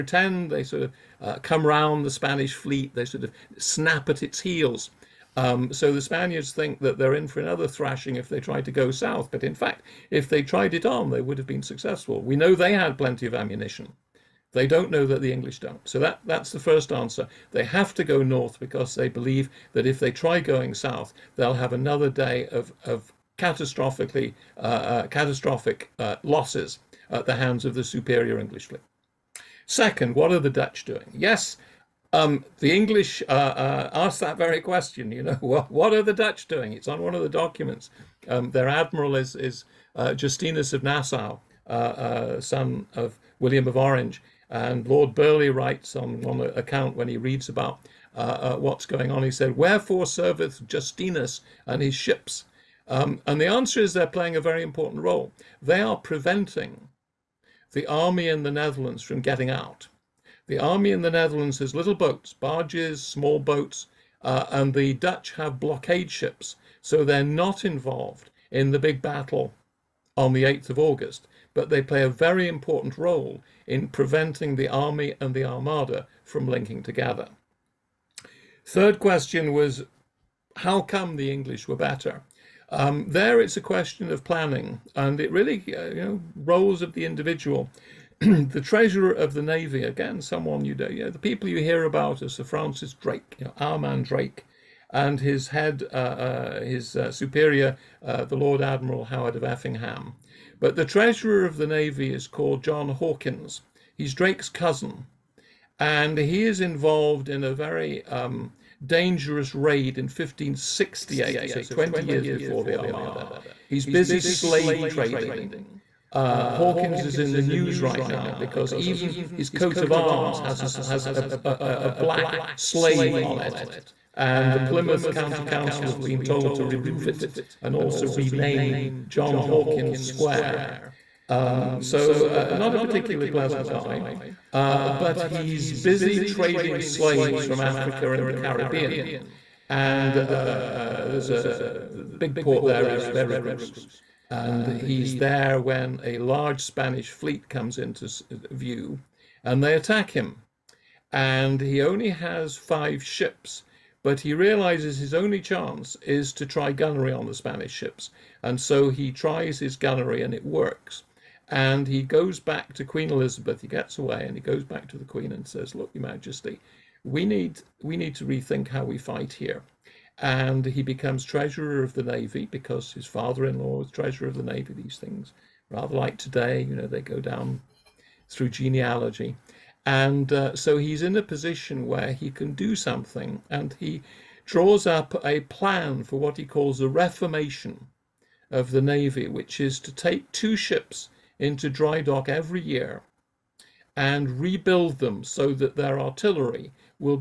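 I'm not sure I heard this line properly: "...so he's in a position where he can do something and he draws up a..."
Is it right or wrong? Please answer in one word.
right.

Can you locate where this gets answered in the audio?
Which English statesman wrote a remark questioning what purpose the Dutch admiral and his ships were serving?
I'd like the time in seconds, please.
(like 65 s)
44 s.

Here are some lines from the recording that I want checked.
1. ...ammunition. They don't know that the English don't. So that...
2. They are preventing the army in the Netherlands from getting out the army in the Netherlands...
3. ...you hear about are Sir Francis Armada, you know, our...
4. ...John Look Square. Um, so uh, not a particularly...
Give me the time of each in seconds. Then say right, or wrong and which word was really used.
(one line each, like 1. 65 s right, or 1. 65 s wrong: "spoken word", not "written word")
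1. 13 s right
2. 55 s right
3. 91 s wrong: "Drake", not "Armada"
4. 129 s wrong: "Hawkins", not "Look".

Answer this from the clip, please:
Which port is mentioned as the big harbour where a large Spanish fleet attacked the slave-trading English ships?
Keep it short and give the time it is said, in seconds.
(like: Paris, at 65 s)
Veracruz, at 143 s.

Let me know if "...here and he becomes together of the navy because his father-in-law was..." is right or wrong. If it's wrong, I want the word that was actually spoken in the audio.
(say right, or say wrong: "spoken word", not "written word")
wrong: "treasurer", not "together".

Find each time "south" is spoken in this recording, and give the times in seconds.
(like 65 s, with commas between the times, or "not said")
8 s, 20 s.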